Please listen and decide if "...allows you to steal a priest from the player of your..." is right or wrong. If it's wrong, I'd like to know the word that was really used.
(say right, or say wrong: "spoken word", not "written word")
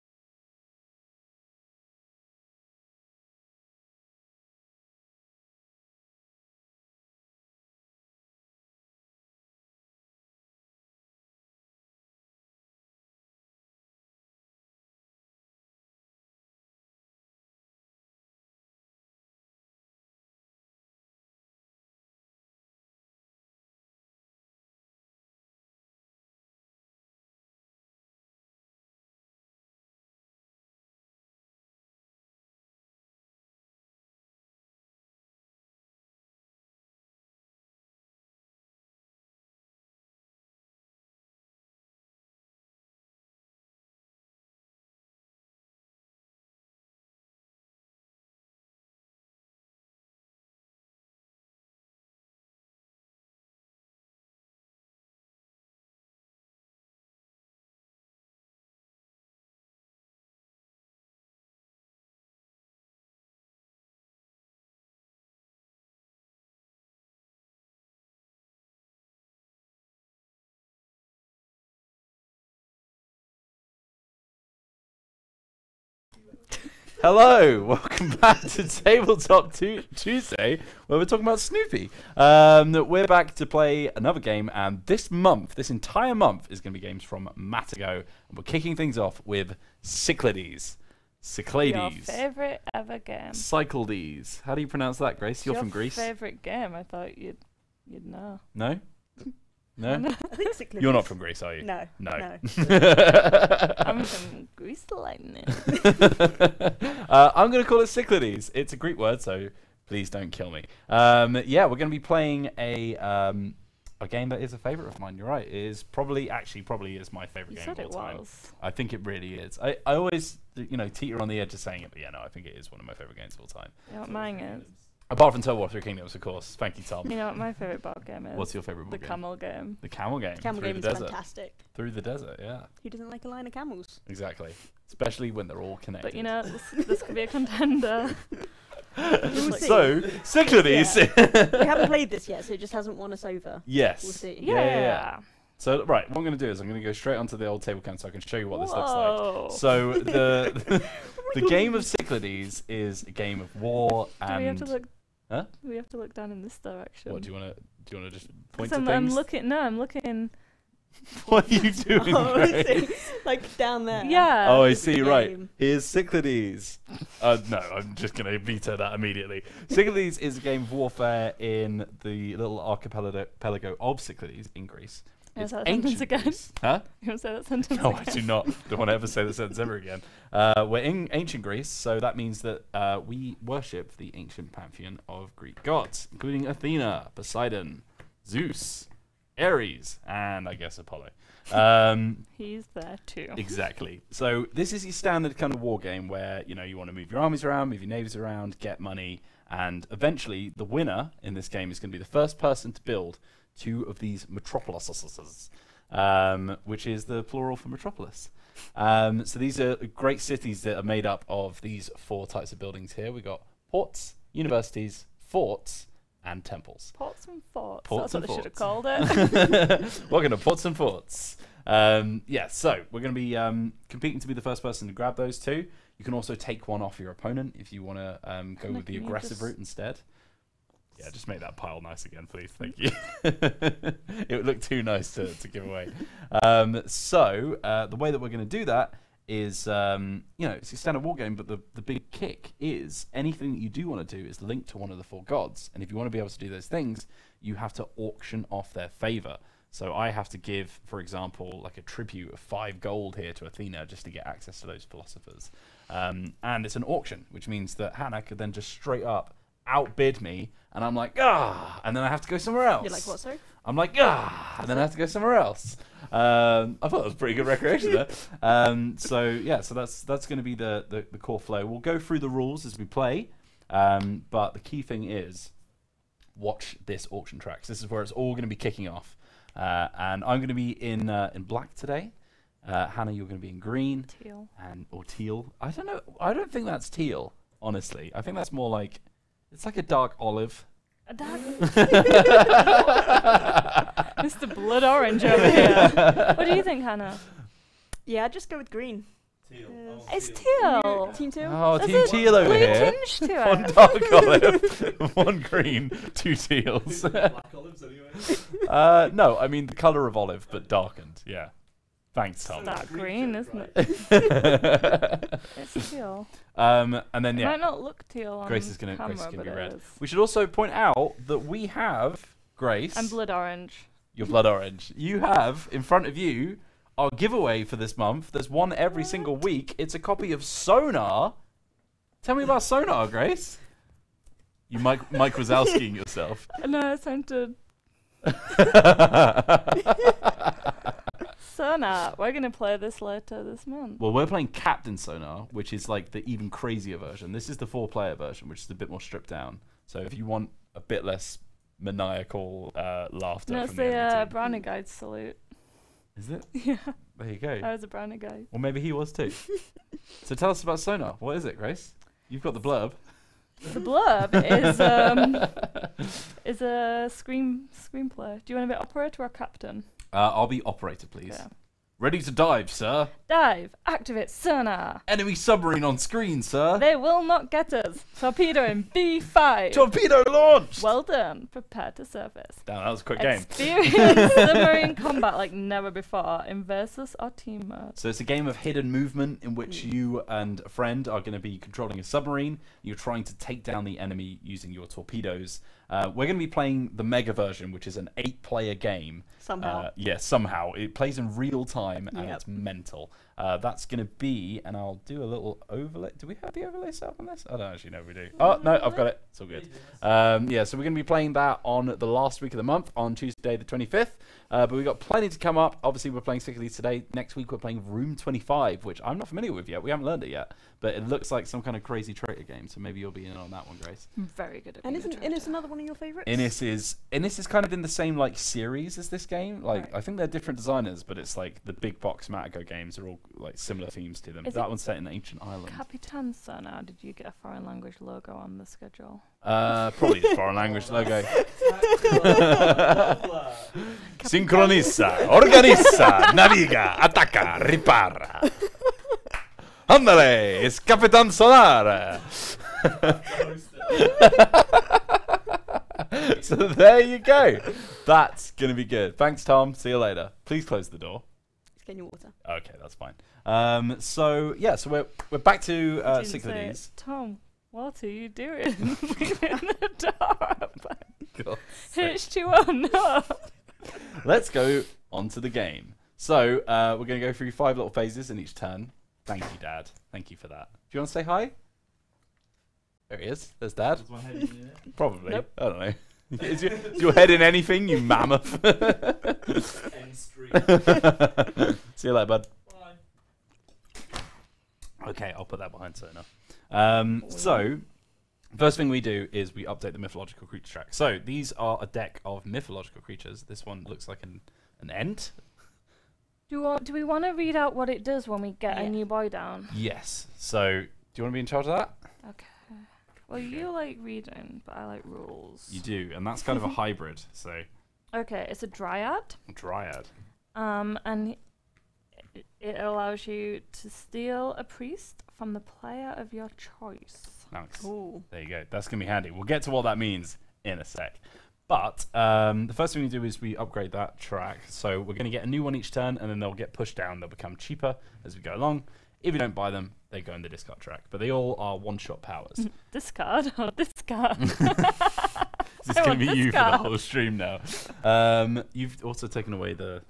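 right.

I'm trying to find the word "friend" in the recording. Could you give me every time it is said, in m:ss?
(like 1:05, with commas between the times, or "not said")
6:30.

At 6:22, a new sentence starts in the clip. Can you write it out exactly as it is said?
Damn, that was a quick Experience game.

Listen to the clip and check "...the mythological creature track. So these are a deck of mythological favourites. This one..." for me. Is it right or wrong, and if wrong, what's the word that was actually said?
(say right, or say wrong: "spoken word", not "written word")
wrong: "creatures", not "favourites".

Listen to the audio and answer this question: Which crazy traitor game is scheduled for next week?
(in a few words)
Room 25.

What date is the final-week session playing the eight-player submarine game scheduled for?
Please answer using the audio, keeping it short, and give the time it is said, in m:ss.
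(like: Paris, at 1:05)
Tuesday the 25th, at 6:53.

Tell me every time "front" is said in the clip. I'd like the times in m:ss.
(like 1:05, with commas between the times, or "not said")
5:25.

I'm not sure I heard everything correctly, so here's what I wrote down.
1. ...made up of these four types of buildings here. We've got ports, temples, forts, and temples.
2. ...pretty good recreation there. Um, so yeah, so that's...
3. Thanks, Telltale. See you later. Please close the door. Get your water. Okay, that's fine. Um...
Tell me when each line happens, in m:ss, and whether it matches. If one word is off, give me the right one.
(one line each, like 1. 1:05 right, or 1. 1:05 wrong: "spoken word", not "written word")
1. 3:30 wrong: "universities", not "temples"
2. 4:27 right
3. 7:39 wrong: "Tom", not "Telltale".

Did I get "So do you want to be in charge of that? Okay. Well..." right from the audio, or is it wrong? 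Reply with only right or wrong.
right.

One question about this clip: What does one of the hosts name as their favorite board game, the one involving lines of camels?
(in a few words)
Through the Desert.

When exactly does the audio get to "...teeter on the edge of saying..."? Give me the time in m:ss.
2:00.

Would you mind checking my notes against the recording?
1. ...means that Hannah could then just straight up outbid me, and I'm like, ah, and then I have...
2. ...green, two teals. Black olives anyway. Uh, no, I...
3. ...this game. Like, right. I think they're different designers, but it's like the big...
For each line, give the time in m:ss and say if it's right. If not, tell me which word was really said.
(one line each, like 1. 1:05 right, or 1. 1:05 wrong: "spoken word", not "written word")
1. 4:17 right
2. 5:05 right
3. 7:09 right.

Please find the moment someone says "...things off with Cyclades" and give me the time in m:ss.
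1:28.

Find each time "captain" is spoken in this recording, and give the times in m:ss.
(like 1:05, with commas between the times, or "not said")
5:44, 6:09.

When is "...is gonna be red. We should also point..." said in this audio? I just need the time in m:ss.
5:19.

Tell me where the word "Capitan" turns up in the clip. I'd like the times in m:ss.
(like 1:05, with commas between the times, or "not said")
7:15, 7:30.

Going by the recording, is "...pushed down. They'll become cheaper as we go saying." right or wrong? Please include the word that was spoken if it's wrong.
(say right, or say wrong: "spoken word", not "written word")
wrong: "along", not "saying".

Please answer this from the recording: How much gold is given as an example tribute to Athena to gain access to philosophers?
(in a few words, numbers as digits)
5.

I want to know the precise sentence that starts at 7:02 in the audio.
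So maybe you'll be in on that one, Grace.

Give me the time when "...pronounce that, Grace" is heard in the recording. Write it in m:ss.
1:34.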